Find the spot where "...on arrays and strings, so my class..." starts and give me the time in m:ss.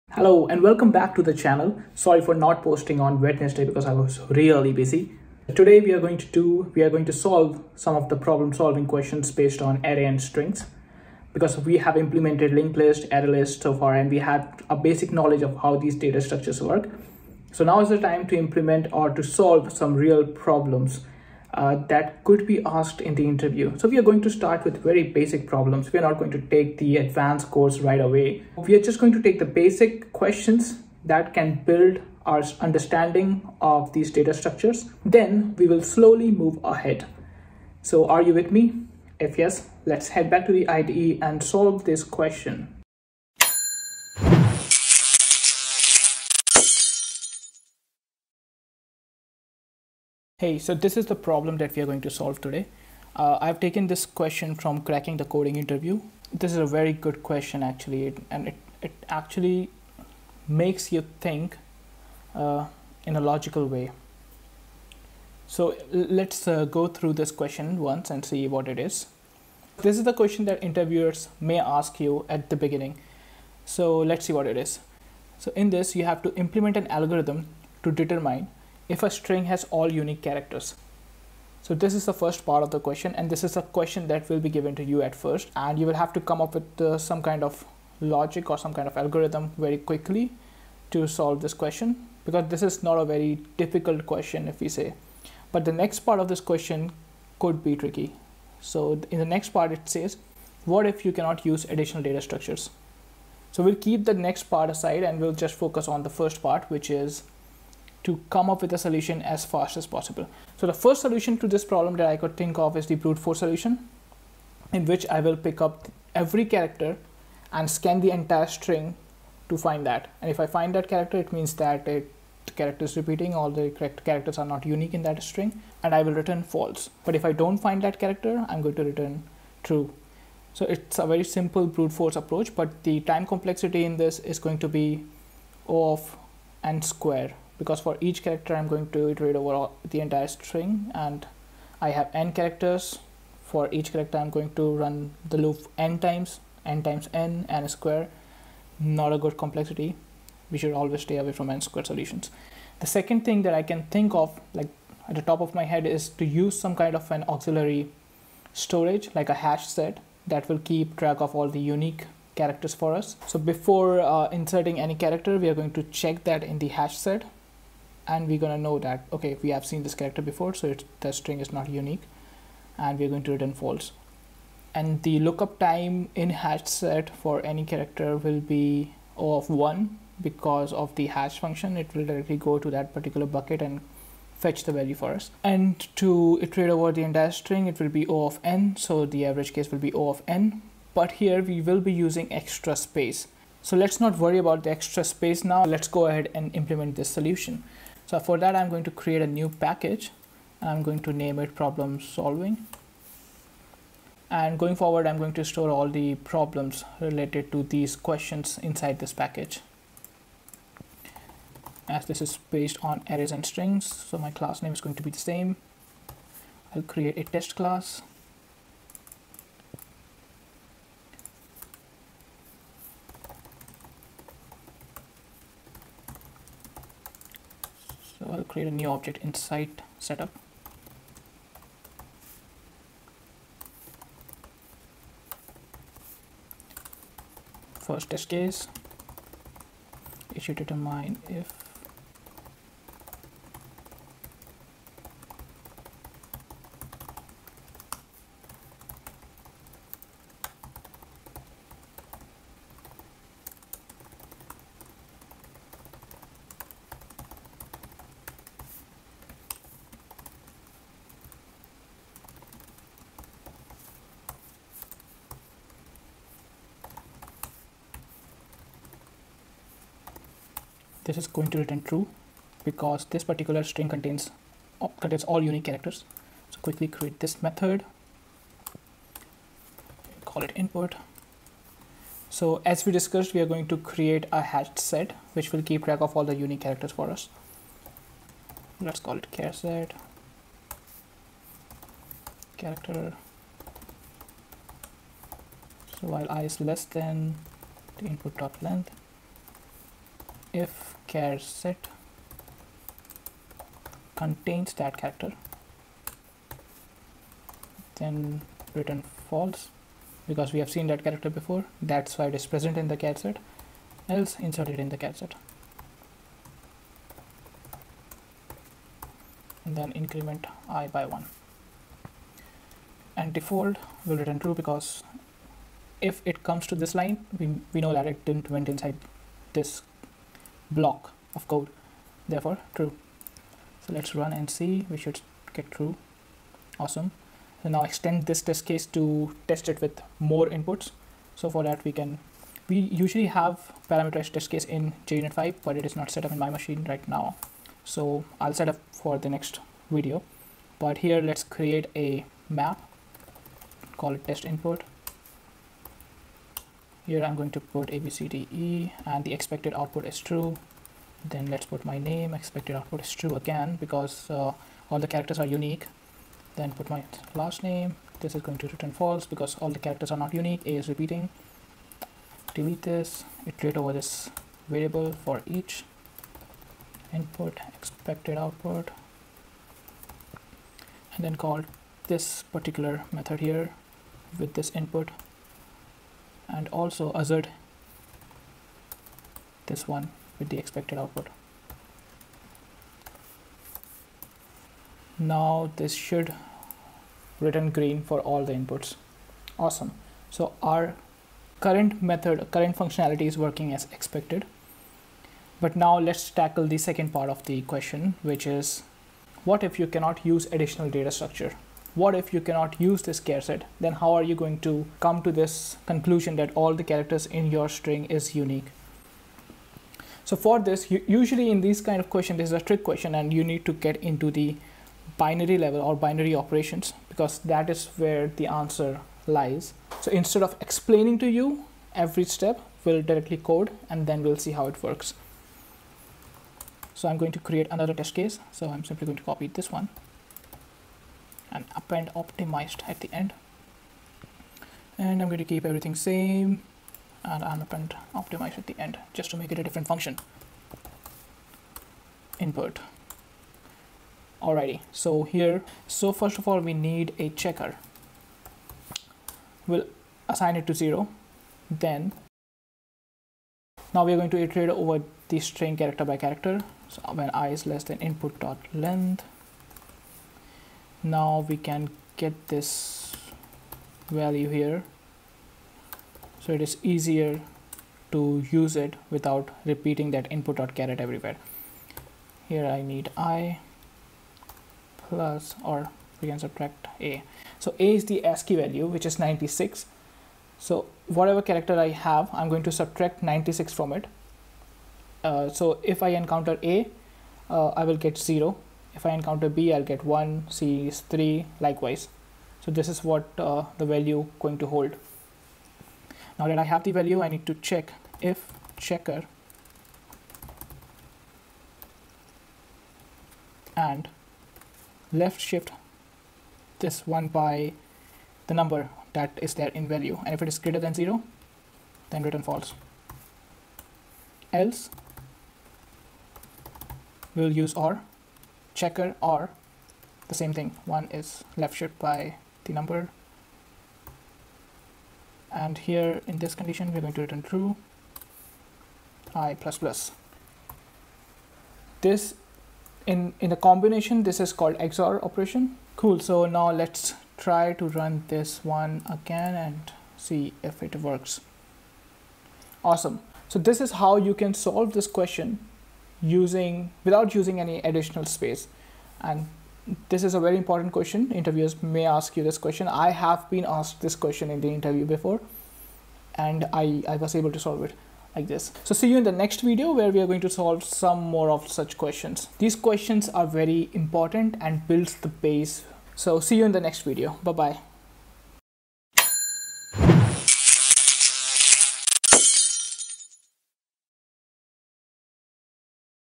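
3:32.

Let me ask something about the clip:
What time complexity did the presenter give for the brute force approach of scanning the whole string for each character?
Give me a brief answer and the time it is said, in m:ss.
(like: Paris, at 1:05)
O(n²), at 2:15.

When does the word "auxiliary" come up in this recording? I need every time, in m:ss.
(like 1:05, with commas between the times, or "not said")
2:37.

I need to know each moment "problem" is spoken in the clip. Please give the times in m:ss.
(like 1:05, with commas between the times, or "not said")
0:08, 0:20, 0:25, 0:51, 1:51, 3:21, 3:26.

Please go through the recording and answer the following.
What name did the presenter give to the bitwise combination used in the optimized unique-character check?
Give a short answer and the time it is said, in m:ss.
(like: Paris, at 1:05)
XOR operation, at 9:04.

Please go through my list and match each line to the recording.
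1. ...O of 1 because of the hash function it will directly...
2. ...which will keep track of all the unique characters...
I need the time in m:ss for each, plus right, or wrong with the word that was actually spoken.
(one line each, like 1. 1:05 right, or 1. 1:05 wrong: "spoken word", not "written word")
1. 2:59 right
2. 4:45 right.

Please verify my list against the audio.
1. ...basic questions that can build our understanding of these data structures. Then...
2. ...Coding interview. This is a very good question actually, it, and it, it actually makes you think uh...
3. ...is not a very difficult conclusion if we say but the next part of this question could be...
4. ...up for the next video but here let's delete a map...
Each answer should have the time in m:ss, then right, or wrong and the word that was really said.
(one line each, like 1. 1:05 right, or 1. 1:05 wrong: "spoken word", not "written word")
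1. 0:29 right
2. 0:55 right
3. 1:32 wrong: "question", not "conclusion"
4. 5:48 wrong: "create", not "delete".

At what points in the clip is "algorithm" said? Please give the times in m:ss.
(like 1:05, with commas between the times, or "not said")
1:16, 1:28.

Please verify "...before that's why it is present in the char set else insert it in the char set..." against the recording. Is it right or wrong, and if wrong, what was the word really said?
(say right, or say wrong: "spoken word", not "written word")
right.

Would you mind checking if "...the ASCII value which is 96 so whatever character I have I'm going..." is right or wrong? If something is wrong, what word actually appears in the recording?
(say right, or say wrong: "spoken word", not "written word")
right.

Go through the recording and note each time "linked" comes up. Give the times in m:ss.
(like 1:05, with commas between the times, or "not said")
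0:12.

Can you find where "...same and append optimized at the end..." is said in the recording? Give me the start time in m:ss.
7:25.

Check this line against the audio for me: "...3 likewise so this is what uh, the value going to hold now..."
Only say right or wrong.
right.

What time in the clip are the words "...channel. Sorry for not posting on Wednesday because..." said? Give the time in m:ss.
0:01.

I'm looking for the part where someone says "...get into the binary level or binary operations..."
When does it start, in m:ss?
7:03.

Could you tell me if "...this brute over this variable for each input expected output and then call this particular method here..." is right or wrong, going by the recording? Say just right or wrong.
wrong.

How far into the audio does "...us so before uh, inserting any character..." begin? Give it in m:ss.
2:42.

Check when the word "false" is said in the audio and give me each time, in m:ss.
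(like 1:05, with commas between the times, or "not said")
2:06, 2:53, 5:09, 6:08, 8:42.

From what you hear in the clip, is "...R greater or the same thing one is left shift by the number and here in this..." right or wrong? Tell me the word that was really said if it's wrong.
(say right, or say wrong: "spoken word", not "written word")
wrong: "checker", not "greater".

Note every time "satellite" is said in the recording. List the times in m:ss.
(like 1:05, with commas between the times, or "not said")
not said.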